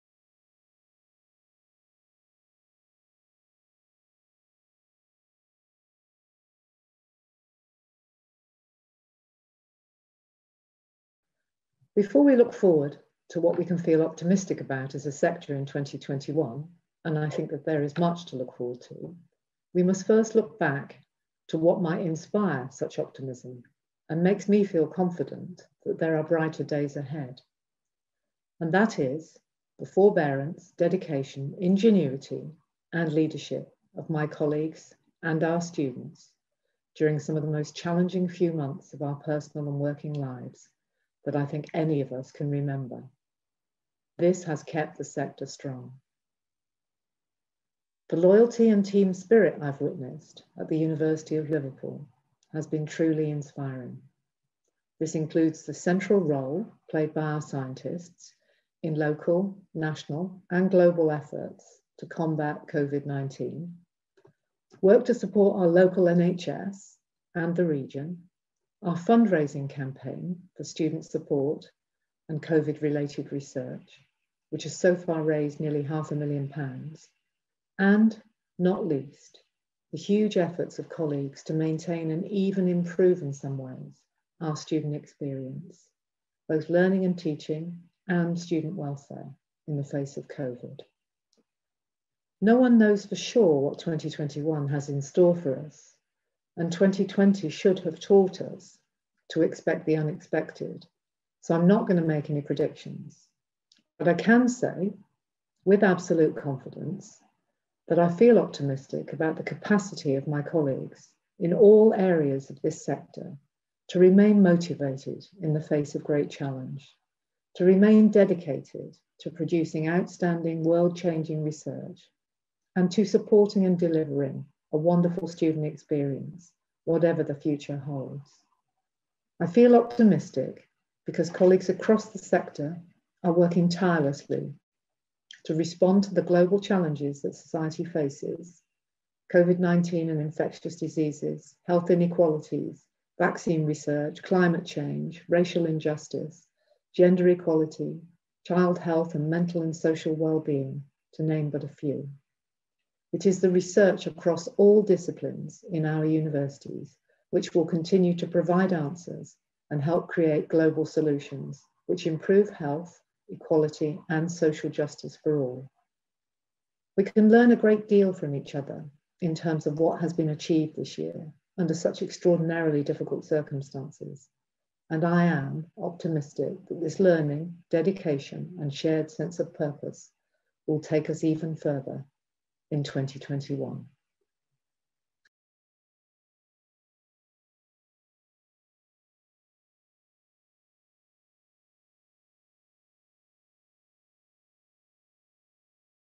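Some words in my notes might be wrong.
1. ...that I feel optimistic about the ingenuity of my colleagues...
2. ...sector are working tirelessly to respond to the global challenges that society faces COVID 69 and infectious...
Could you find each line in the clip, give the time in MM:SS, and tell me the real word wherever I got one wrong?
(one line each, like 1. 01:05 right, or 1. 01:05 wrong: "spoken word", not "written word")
1. 01:47 wrong: "capacity", not "ingenuity"
2. 02:12 wrong: "19", not "69".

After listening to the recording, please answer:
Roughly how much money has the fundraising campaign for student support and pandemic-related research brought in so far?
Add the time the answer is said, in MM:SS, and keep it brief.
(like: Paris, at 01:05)
Nearly half a million pounds, at 01:15.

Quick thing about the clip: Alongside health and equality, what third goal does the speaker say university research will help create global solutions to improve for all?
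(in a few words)
Social justice.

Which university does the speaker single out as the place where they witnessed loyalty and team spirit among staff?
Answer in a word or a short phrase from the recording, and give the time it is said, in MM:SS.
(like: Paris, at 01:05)
University of Liverpool, at 00:50.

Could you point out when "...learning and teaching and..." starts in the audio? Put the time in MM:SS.
01:26.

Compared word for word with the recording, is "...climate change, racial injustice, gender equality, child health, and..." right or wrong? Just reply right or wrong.
right.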